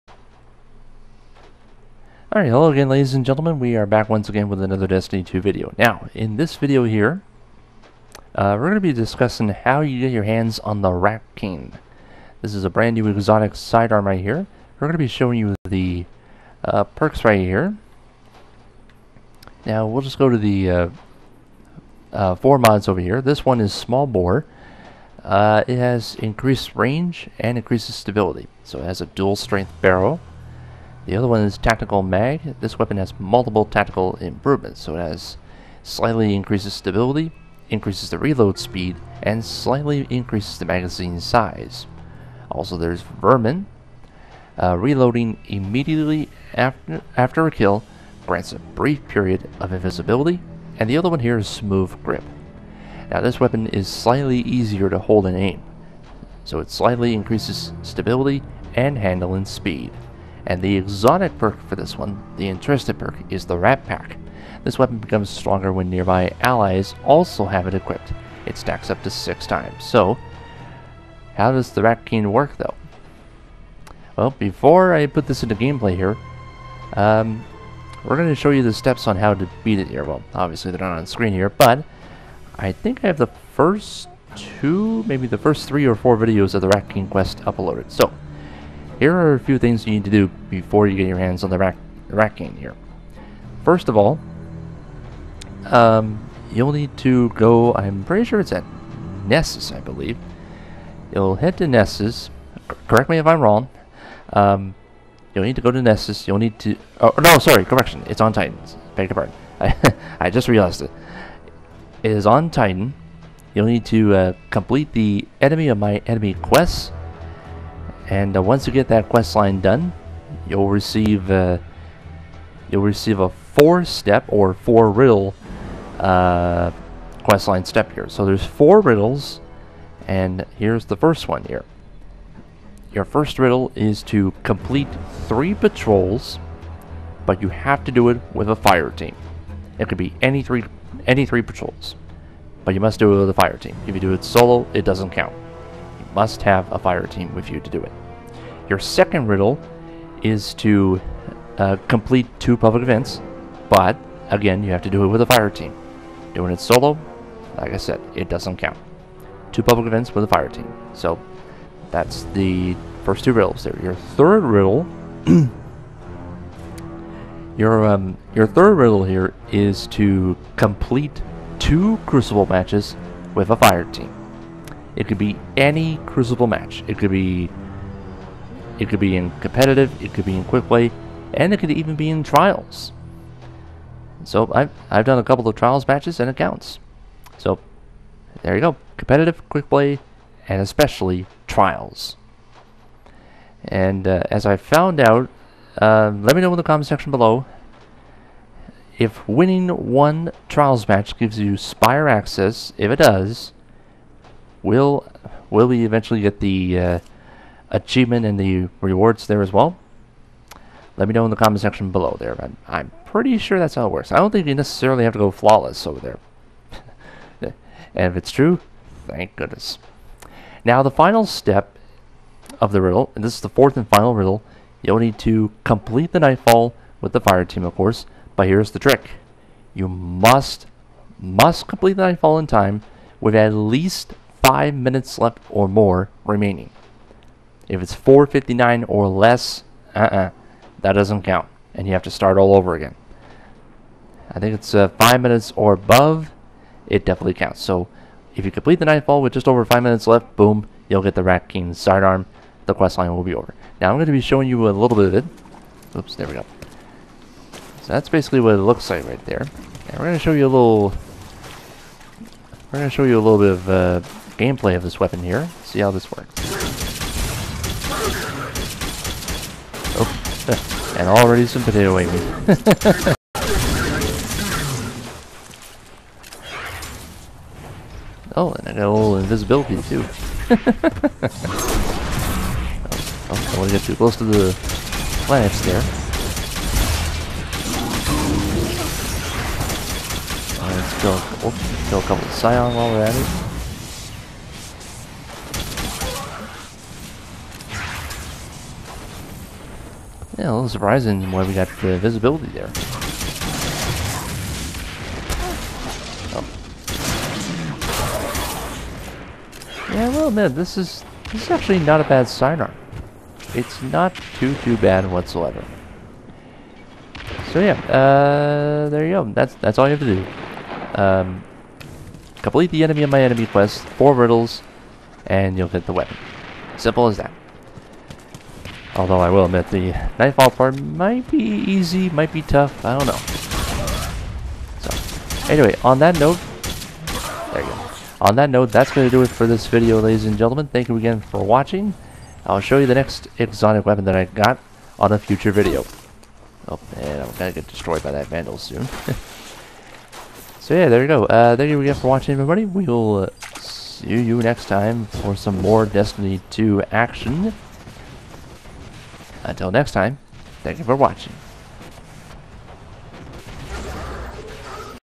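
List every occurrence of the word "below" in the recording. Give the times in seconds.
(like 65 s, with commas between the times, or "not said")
197 s, 211 s.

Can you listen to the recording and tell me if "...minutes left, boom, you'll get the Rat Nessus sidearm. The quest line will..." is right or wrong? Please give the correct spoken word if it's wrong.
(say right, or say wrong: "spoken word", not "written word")
wrong: "King", not "Nessus".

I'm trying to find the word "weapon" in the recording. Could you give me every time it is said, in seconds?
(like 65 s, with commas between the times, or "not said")
32 s, 53 s, 64 s, 264 s, 325 s, 343 s.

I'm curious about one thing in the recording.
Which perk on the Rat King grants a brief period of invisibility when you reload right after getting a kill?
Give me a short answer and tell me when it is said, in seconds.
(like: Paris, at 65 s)
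Vermin, at 43 s.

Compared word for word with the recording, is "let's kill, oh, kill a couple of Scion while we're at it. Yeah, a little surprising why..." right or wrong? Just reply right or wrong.
right.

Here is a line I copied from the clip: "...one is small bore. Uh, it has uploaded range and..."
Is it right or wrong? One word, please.
wrong.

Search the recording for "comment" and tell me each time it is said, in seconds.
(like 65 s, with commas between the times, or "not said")
196 s, 211 s.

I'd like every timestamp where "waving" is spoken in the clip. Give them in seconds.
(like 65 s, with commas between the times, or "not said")
271 s.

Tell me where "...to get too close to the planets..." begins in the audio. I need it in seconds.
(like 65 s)
283 s.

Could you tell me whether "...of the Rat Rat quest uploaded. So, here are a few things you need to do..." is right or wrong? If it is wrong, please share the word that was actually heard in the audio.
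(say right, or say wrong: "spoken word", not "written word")
wrong: "King", not "Rat".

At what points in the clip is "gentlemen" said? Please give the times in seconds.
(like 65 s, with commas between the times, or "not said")
3 s, 340 s.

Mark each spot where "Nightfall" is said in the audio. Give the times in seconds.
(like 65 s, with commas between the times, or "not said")
226 s, 232 s, 248 s, 330 s.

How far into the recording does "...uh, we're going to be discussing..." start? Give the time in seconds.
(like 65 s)
8 s.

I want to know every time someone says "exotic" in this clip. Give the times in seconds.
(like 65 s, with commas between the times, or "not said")
13 s, 60 s, 343 s.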